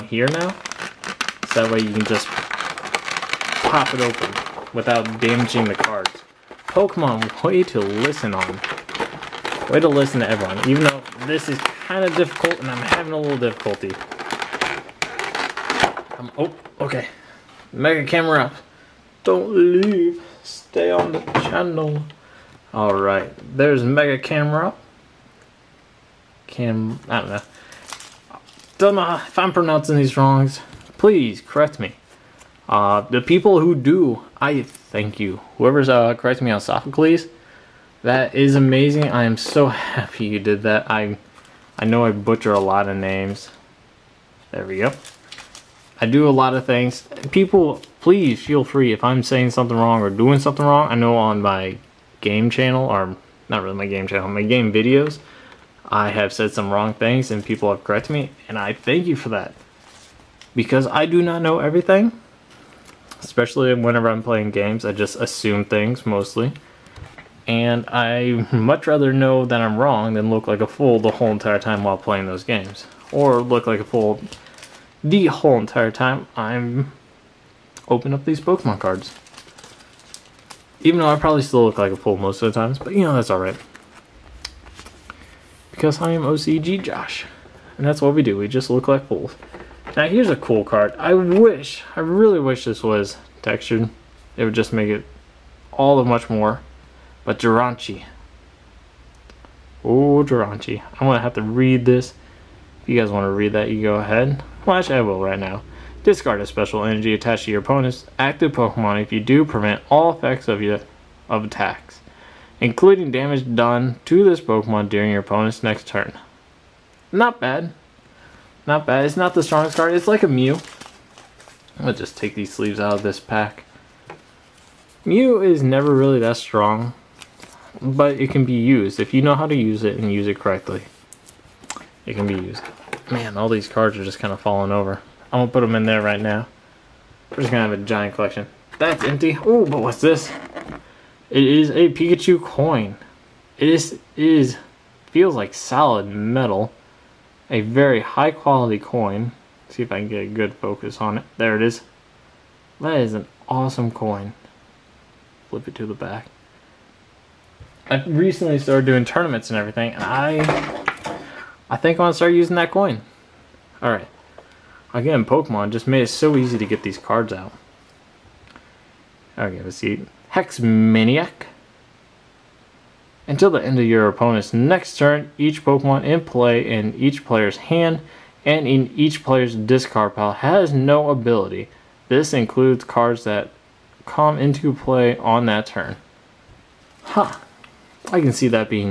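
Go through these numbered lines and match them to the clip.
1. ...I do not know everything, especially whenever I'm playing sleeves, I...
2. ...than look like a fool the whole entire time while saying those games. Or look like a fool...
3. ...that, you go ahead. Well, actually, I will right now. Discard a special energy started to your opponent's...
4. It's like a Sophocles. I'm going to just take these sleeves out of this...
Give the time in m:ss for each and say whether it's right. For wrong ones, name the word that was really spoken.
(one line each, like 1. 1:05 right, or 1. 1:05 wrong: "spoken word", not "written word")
1. 1:00 wrong: "games", not "sleeves"
2. 1:10 wrong: "playing", not "saying"
3. 1:43 wrong: "attached", not "started"
4. 1:59 wrong: "Mew", not "Sophocles".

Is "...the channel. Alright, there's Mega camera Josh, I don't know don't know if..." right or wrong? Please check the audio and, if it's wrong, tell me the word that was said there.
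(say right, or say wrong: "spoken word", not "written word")
wrong: "Cam", not "Josh".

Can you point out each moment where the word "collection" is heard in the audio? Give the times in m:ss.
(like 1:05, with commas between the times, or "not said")
2:18.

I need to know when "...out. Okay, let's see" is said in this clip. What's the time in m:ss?
2:47.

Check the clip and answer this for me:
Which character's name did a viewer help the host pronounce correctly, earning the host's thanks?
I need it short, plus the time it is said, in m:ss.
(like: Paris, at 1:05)
Sophocles, at 0:36.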